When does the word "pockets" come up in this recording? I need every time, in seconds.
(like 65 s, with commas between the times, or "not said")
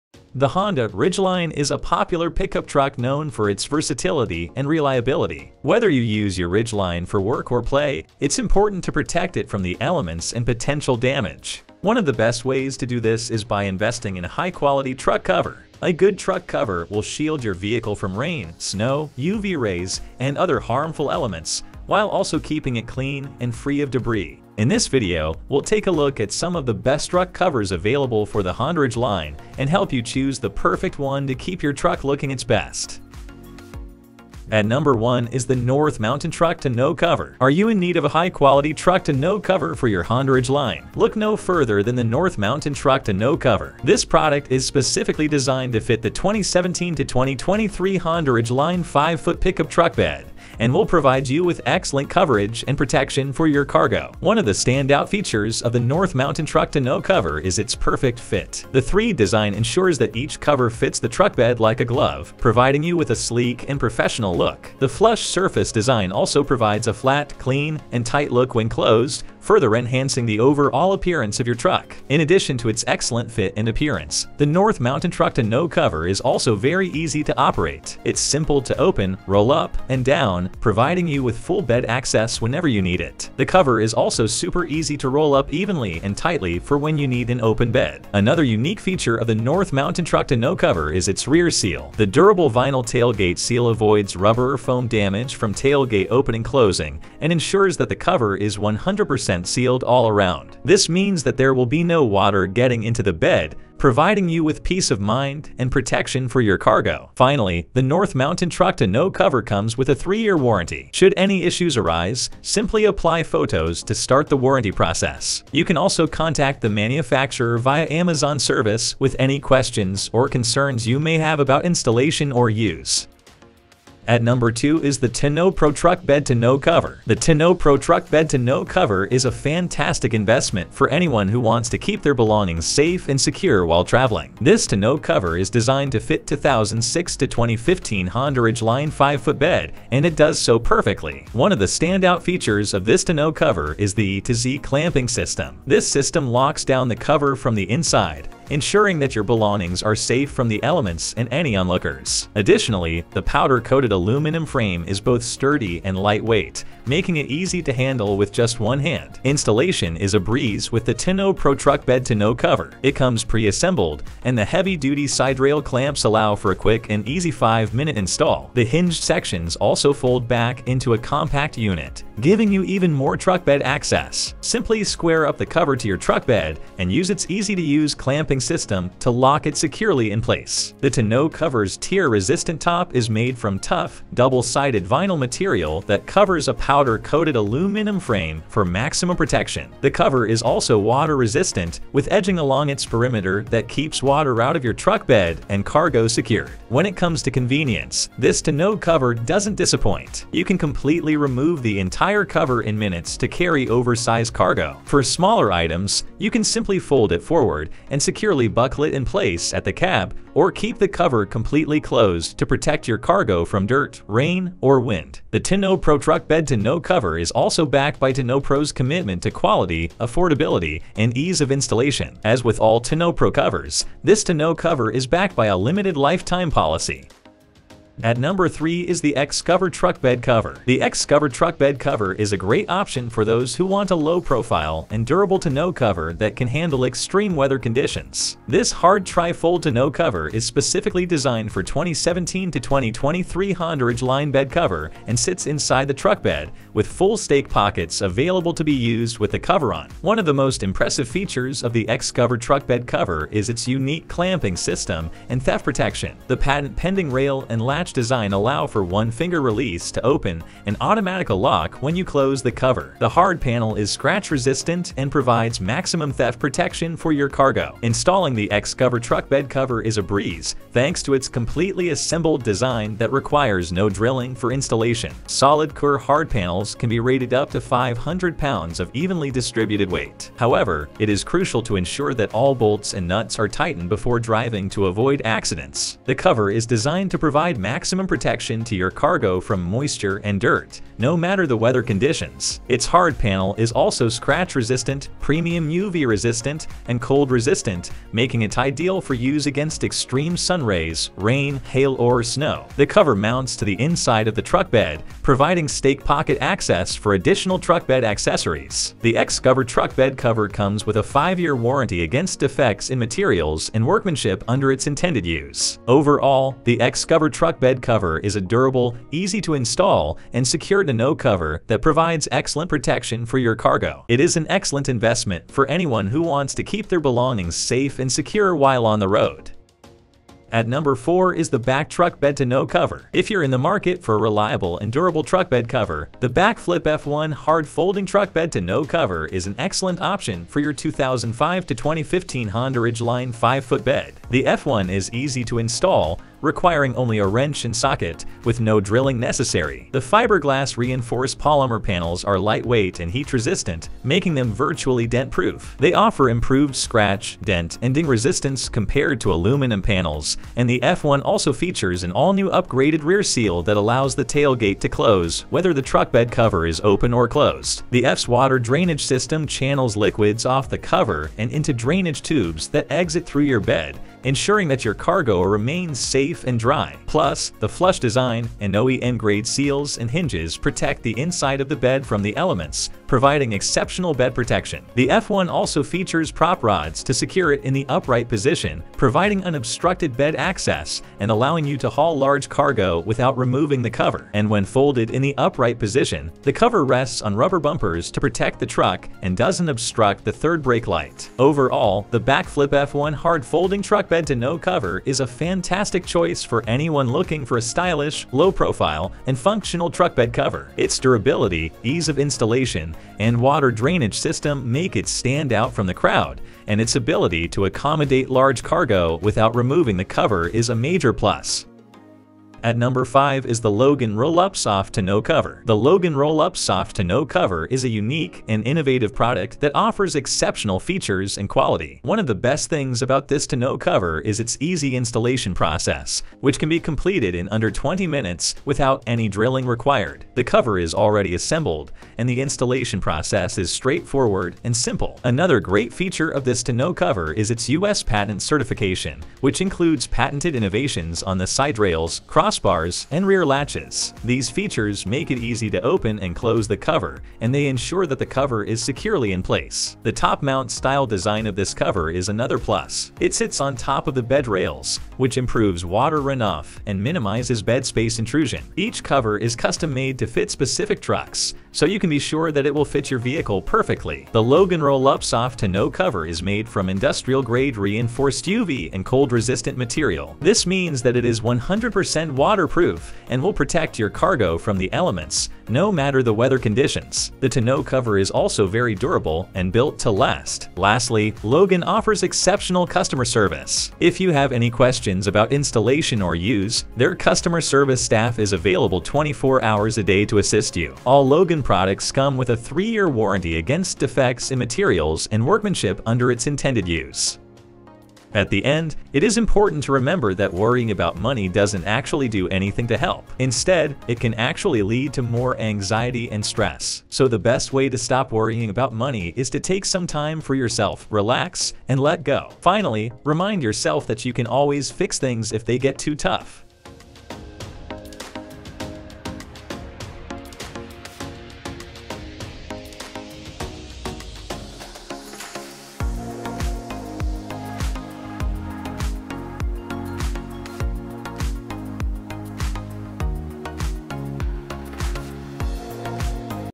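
247 s, 306 s.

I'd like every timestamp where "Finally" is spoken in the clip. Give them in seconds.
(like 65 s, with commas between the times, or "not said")
107 s, 522 s.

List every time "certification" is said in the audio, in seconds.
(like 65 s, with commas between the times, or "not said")
448 s.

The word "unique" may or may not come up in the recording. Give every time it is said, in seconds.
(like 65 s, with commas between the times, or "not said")
88 s, 253 s, 427 s.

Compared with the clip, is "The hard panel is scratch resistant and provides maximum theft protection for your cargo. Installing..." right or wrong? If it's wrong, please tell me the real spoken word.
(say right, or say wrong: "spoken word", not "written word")
right.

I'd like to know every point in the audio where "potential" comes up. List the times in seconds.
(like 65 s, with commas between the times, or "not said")
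10 s.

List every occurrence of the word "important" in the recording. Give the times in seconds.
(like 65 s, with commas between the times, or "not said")
8 s, 509 s.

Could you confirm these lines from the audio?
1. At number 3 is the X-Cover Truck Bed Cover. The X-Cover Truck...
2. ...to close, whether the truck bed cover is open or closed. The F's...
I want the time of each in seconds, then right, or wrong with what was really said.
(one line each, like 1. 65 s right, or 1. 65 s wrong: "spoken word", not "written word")
1. 228 s right
2. 364 s right.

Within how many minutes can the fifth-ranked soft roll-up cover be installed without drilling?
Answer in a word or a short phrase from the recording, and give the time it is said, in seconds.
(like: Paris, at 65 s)
20 minutes, at 437 s.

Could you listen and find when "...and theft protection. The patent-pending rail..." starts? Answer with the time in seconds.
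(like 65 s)
255 s.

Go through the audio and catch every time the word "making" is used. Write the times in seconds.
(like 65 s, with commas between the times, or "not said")
156 s, 298 s, 354 s.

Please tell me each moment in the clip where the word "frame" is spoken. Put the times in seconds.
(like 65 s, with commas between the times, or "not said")
154 s, 187 s.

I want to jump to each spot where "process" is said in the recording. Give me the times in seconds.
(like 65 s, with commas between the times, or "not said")
114 s, 435 s, 443 s.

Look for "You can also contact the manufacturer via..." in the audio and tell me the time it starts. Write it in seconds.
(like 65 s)
115 s.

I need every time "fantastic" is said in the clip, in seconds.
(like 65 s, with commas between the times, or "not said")
129 s, 405 s.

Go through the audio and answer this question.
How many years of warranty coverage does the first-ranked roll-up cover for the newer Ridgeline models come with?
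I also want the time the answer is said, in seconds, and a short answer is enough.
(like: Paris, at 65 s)
3-year, at 109 s.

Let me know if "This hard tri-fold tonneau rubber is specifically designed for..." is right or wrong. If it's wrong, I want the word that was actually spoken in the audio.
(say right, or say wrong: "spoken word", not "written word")
wrong: "cover", not "rubber".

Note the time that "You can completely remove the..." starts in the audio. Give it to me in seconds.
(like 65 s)
200 s.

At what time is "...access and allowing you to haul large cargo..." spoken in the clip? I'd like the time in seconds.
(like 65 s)
390 s.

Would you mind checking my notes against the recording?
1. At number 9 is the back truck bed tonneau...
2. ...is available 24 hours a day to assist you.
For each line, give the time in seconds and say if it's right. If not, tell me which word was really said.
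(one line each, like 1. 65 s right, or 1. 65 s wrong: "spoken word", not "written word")
1. 330 s wrong: "4", not "9"
2. 498 s right.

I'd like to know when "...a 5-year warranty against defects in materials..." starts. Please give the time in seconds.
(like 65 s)
310 s.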